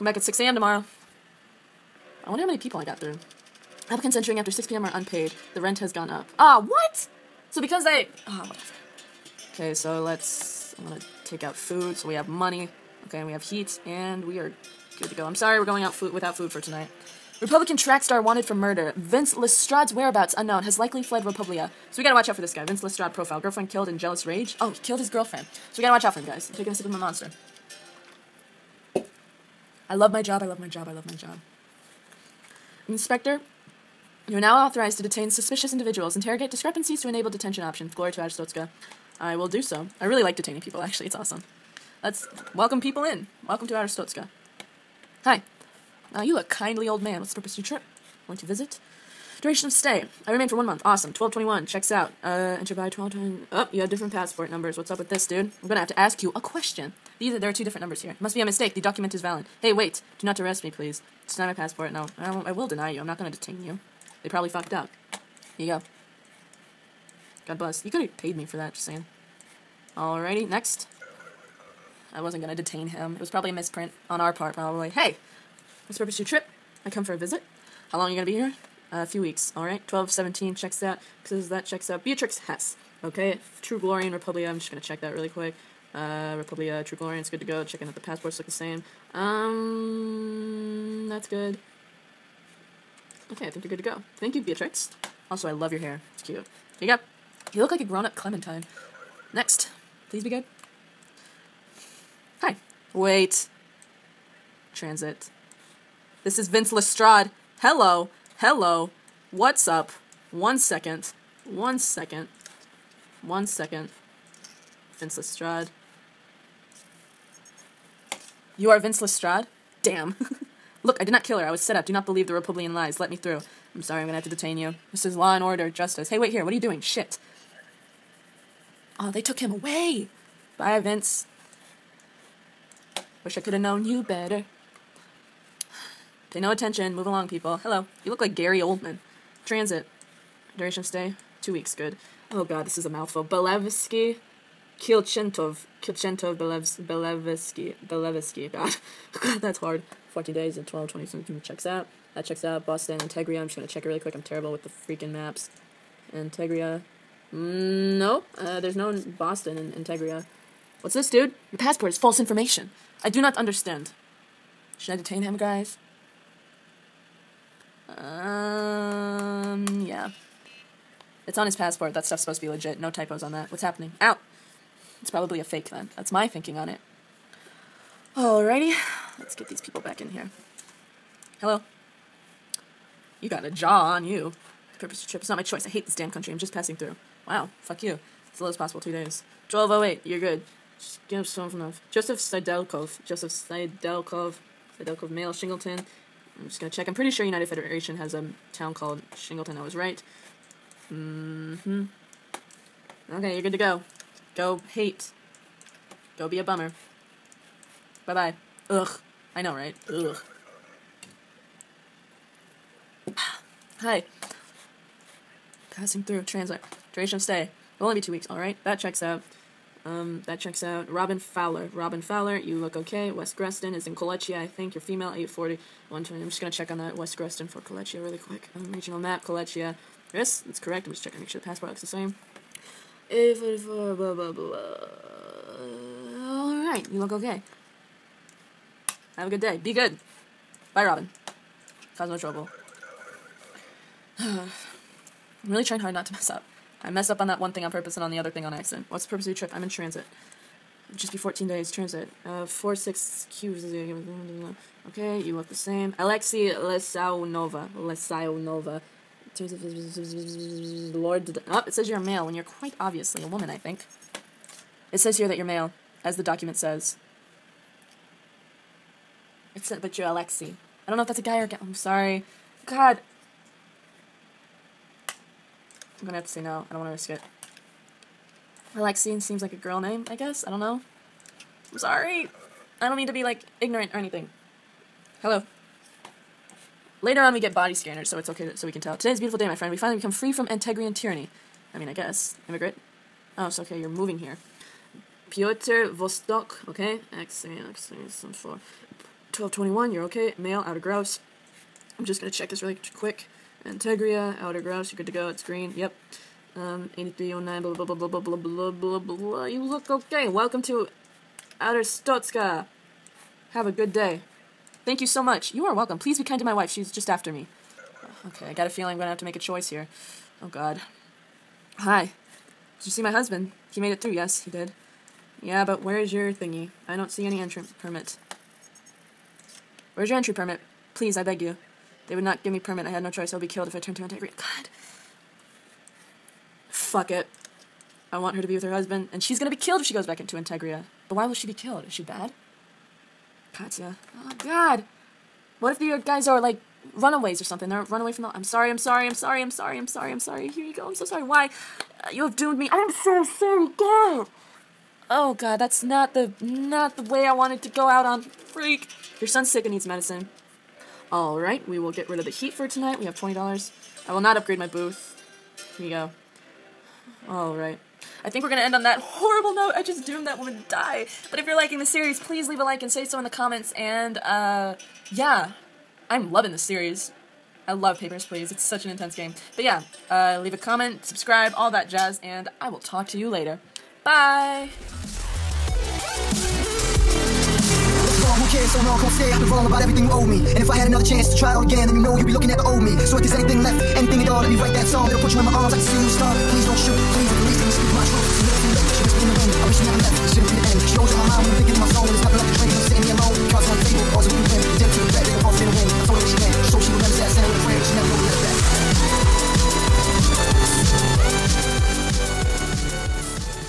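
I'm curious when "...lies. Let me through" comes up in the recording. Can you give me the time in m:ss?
2:02.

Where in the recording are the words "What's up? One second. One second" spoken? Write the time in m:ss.
1:49.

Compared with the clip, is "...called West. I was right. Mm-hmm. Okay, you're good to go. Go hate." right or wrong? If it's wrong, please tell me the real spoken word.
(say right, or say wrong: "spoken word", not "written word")
wrong: "Shingleton", not "West".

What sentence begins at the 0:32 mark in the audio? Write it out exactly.
Inspector, you are now authorized to detain suspicious individuals.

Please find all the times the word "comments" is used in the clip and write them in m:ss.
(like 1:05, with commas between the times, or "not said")
6:13, 6:20.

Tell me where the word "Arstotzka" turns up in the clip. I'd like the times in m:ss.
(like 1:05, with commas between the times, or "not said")
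0:38, 0:43, 5:11.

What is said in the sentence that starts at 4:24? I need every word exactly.
It says here that you're male, as the document says.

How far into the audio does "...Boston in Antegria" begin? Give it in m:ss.
2:39.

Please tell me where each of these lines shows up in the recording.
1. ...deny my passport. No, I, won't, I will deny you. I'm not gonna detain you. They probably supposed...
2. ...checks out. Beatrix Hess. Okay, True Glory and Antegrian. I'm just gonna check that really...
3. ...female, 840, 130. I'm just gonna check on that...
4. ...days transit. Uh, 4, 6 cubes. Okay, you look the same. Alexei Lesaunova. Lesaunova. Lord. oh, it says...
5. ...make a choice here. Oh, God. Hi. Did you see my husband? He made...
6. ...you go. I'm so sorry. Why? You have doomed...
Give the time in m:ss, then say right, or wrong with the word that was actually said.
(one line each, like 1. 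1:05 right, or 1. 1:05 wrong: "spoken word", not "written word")
1. 1:01 wrong: "fucked", not "supposed"
2. 1:21 wrong: "Republia", not "Antegrian"
3. 3:44 wrong: "120", not "130"
4. 4:11 right
5. 5:19 right
6. 5:50 right.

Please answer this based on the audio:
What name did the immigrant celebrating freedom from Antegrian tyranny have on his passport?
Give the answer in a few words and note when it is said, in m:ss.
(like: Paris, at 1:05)
Piotr Vostok, at 4:55.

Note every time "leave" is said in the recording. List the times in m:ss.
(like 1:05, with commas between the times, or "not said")
6:12, 6:20.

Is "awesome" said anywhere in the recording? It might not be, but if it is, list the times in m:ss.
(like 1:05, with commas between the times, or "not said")
0:41, 0:50.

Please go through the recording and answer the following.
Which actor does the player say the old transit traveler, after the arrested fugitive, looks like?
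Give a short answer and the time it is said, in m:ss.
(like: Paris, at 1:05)
Gary Oldman, at 2:18.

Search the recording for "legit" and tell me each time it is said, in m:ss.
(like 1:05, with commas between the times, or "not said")
2:52.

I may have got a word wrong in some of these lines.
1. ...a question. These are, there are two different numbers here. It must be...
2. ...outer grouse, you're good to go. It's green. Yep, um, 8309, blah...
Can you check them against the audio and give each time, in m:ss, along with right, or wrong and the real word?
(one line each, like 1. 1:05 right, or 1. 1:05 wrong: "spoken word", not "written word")
1. 0:56 right
2. 5:04 right.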